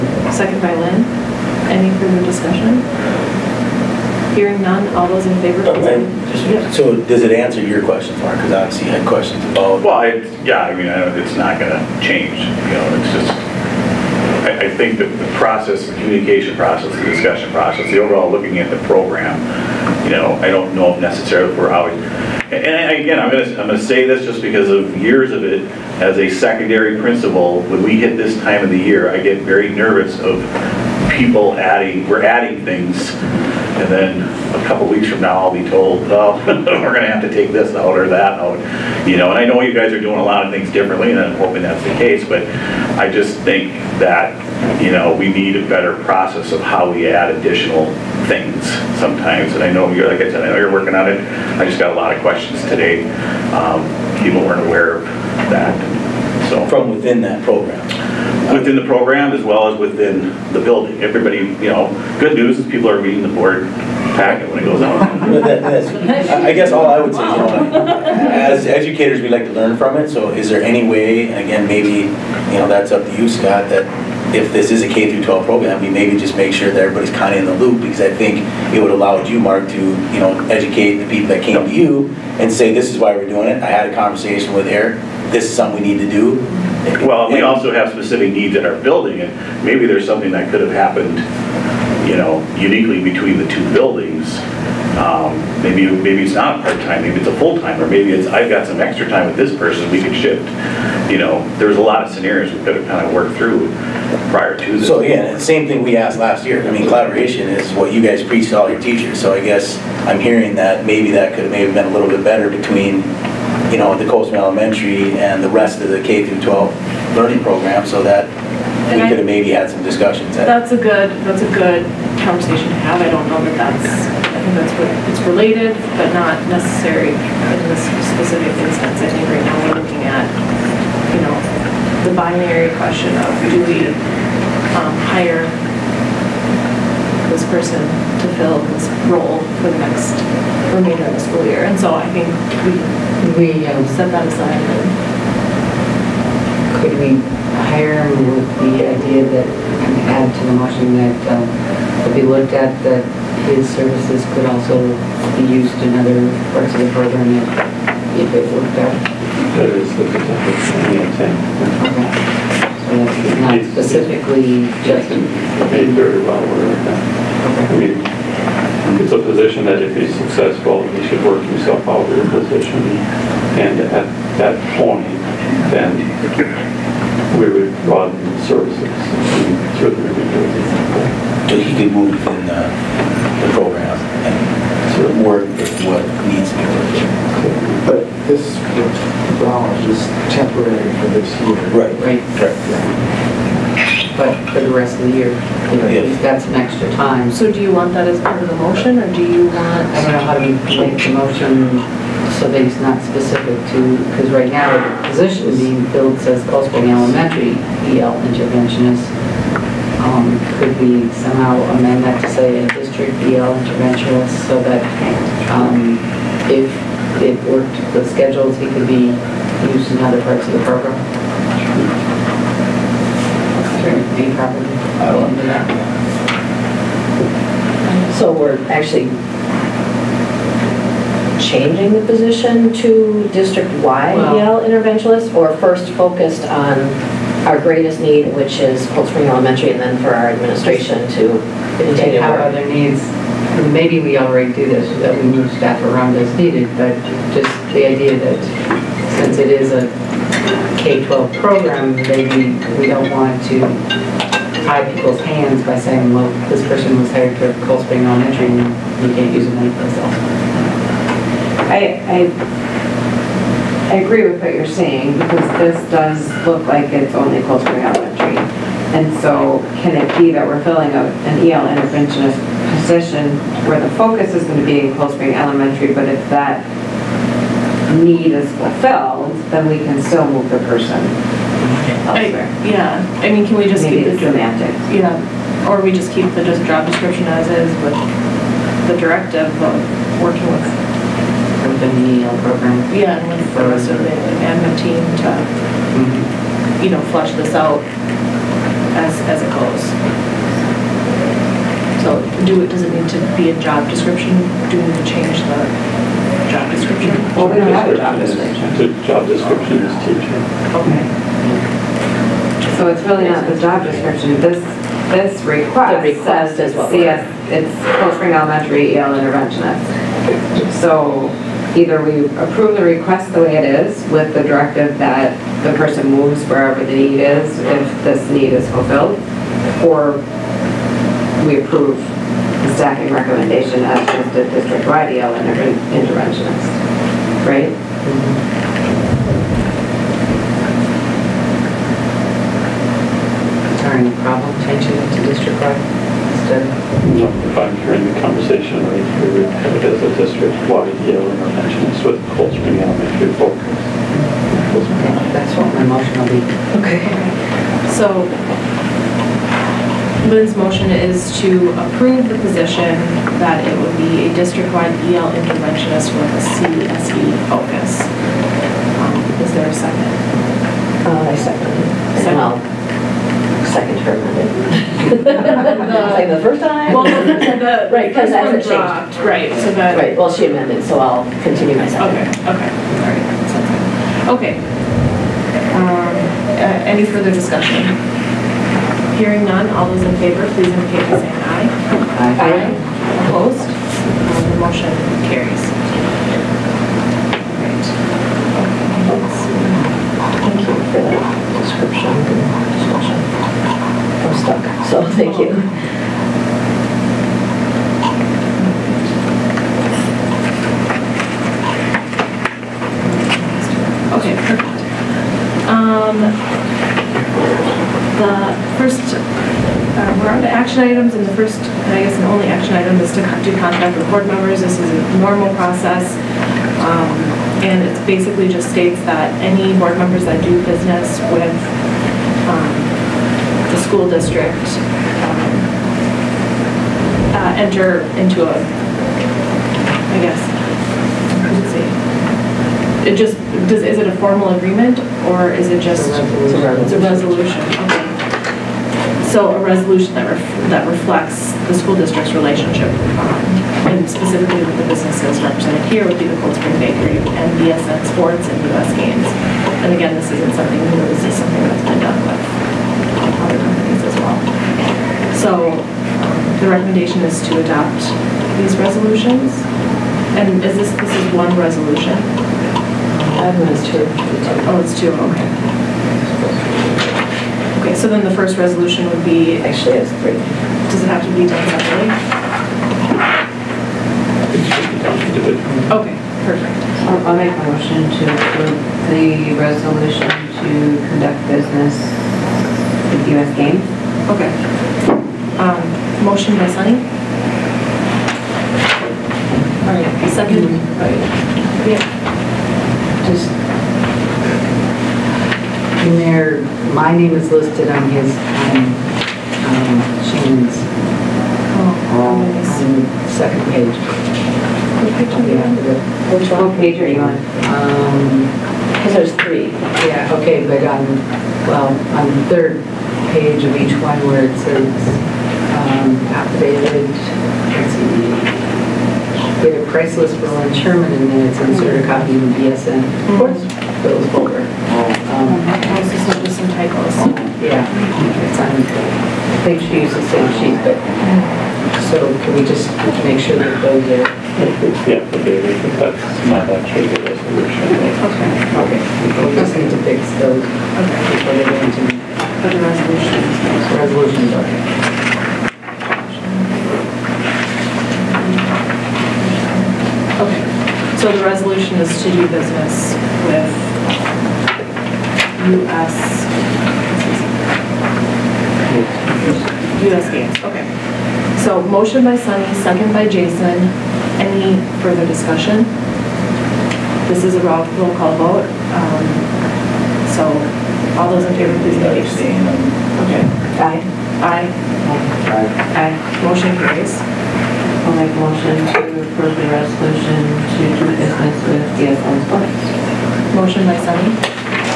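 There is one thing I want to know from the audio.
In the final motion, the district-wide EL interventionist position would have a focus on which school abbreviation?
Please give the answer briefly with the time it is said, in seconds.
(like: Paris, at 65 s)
CSE, at 366 s.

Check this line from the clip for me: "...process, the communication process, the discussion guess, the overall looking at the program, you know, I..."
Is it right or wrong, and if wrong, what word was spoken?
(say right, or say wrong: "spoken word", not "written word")
wrong: "process", not "guess".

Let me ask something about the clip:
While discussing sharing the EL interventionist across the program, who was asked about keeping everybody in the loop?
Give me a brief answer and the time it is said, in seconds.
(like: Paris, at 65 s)
Scott, at 73 s.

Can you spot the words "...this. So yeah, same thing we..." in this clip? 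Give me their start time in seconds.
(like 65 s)
104 s.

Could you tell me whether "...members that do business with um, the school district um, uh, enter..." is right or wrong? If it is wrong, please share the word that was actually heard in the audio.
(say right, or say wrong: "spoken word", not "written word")
right.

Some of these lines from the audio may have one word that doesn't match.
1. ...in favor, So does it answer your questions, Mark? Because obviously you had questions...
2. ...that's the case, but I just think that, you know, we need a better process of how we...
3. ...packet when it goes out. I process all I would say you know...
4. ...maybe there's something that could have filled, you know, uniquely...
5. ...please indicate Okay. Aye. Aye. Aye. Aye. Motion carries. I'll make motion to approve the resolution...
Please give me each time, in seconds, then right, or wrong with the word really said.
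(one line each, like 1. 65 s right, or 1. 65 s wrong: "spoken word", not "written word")
1. 5 s right
2. 41 s right
3. 64 s wrong: "guess", not "process"
4. 89 s wrong: "happened", not "filled"
5. 581 s right.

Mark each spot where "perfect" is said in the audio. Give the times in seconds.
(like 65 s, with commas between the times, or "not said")
414 s, 486 s.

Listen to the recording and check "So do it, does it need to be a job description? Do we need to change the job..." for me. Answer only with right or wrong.
right.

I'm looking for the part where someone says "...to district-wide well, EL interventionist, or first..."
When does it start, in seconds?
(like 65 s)
232 s.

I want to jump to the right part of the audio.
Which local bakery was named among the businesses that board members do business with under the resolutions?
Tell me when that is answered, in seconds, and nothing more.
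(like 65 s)
456 s.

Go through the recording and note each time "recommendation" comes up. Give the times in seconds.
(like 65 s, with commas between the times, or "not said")
333 s, 466 s.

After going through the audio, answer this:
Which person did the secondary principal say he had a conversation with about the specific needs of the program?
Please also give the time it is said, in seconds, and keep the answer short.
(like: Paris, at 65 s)
Eric, at 84 s.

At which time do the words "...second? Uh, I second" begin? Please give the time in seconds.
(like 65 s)
369 s.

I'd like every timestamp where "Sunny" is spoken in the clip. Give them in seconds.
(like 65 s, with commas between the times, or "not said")
496 s, 572 s, 594 s.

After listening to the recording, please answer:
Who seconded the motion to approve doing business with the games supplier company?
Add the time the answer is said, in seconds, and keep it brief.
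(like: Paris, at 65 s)
Jason, at 573 s.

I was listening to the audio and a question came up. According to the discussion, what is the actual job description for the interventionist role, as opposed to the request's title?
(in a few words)
teacher.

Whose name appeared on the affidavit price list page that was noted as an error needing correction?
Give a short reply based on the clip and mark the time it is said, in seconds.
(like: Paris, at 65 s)
Lynn Sherman, at 530 s.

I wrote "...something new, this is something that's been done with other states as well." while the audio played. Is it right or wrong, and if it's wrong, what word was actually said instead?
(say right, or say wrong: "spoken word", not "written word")
wrong: "companies", not "states".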